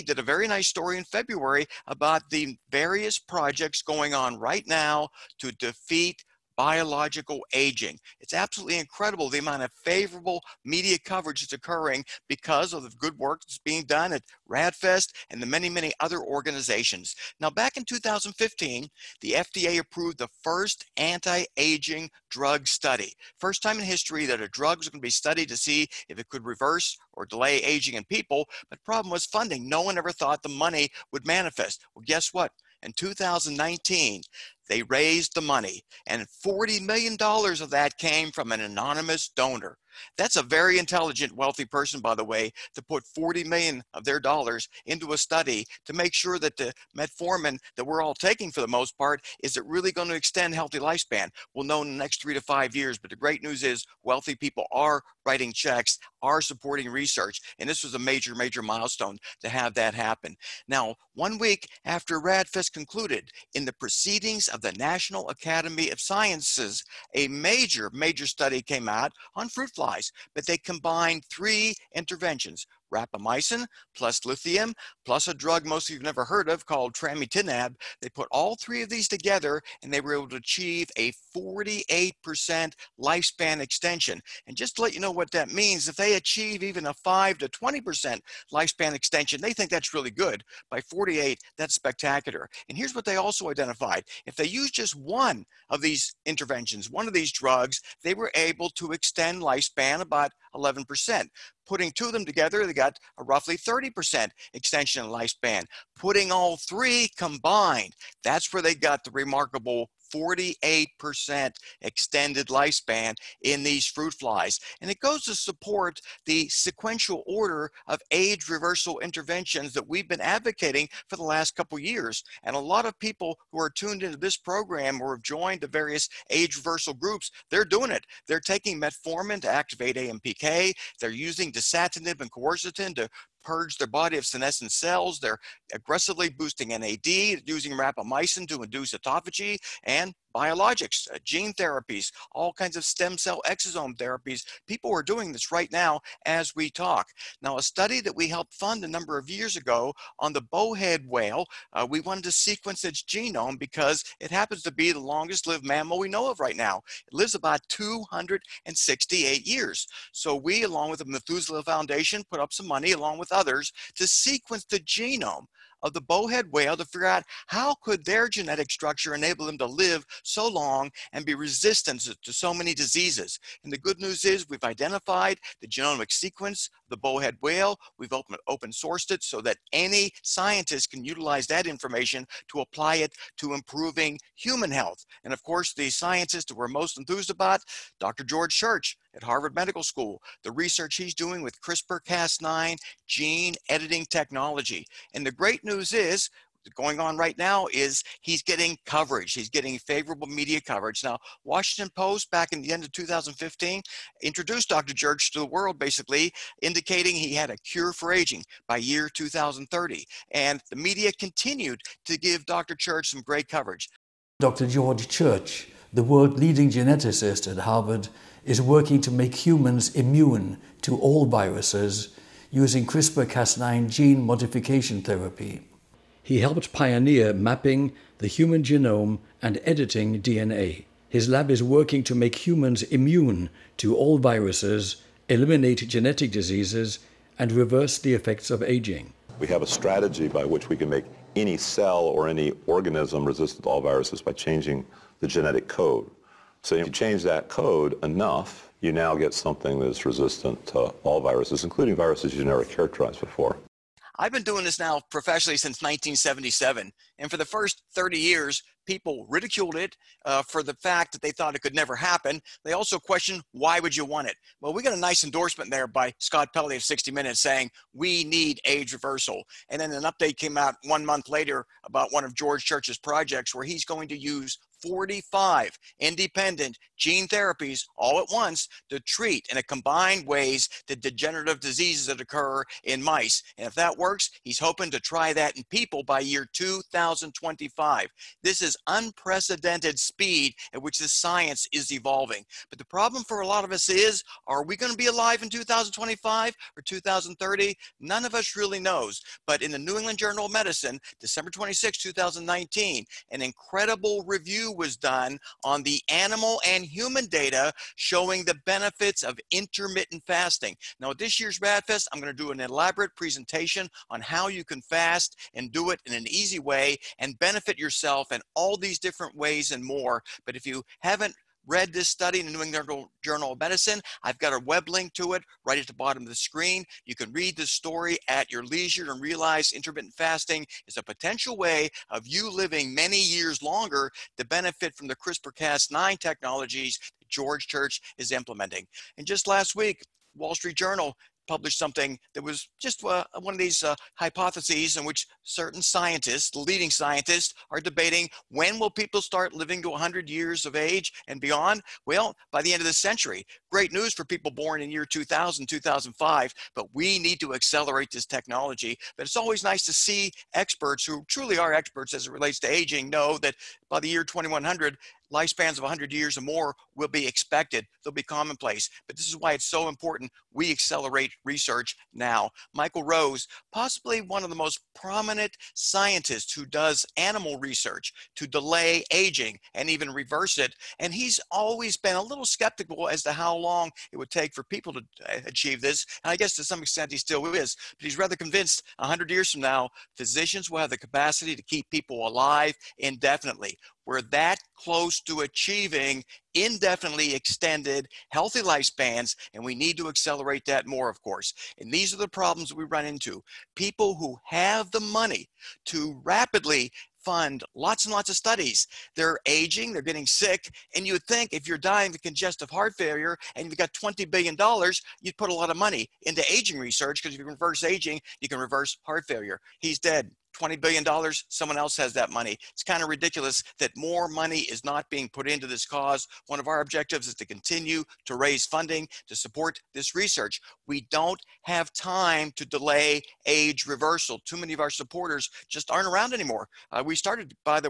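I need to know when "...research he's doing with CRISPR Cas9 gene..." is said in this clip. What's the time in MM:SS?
03:10.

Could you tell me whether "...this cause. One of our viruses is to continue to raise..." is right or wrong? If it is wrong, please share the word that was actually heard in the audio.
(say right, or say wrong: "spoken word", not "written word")
wrong: "objectives", not "viruses".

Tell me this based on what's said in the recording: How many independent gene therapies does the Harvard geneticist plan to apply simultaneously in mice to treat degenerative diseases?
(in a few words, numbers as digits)
45.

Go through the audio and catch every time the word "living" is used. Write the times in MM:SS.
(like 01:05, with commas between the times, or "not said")
05:32, 05:49.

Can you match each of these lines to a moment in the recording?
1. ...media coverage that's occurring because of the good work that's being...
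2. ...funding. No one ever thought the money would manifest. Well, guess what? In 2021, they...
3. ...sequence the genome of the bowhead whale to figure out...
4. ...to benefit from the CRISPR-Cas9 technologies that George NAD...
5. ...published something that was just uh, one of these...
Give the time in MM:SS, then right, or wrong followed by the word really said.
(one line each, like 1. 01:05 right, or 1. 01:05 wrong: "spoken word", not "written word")
1. 00:10 right
2. 00:29 wrong: "2019", not "2021"
3. 02:44 right
4. 05:34 wrong: "Church", not "NAD"
5. 05:41 right.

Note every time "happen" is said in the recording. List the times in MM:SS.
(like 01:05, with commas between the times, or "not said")
00:59, 02:34, 04:21.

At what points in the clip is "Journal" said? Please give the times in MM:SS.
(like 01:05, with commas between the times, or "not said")
05:00, 05:23, 05:40.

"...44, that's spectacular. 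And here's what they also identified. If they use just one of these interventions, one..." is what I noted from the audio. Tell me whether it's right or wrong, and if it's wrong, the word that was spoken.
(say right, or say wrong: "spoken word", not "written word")
wrong: "48", not "44".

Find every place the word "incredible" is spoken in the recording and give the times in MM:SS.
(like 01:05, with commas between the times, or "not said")
00:08, 05:03.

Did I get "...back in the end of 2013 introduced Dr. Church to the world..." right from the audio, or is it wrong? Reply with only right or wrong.
wrong.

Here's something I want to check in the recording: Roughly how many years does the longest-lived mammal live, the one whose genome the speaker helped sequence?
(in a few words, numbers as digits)
268.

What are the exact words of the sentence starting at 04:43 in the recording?
And if that works, he's hoping to try that in people by year 2025.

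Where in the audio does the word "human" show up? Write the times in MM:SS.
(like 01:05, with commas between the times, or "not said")
03:04, 03:39, 03:48, 03:52, 05:06.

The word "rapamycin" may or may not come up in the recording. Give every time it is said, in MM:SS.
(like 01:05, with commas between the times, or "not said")
01:12, 02:17.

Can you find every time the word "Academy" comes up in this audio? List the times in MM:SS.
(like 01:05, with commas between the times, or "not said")
01:05.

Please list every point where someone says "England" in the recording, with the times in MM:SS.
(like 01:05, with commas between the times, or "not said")
04:59, 05:22.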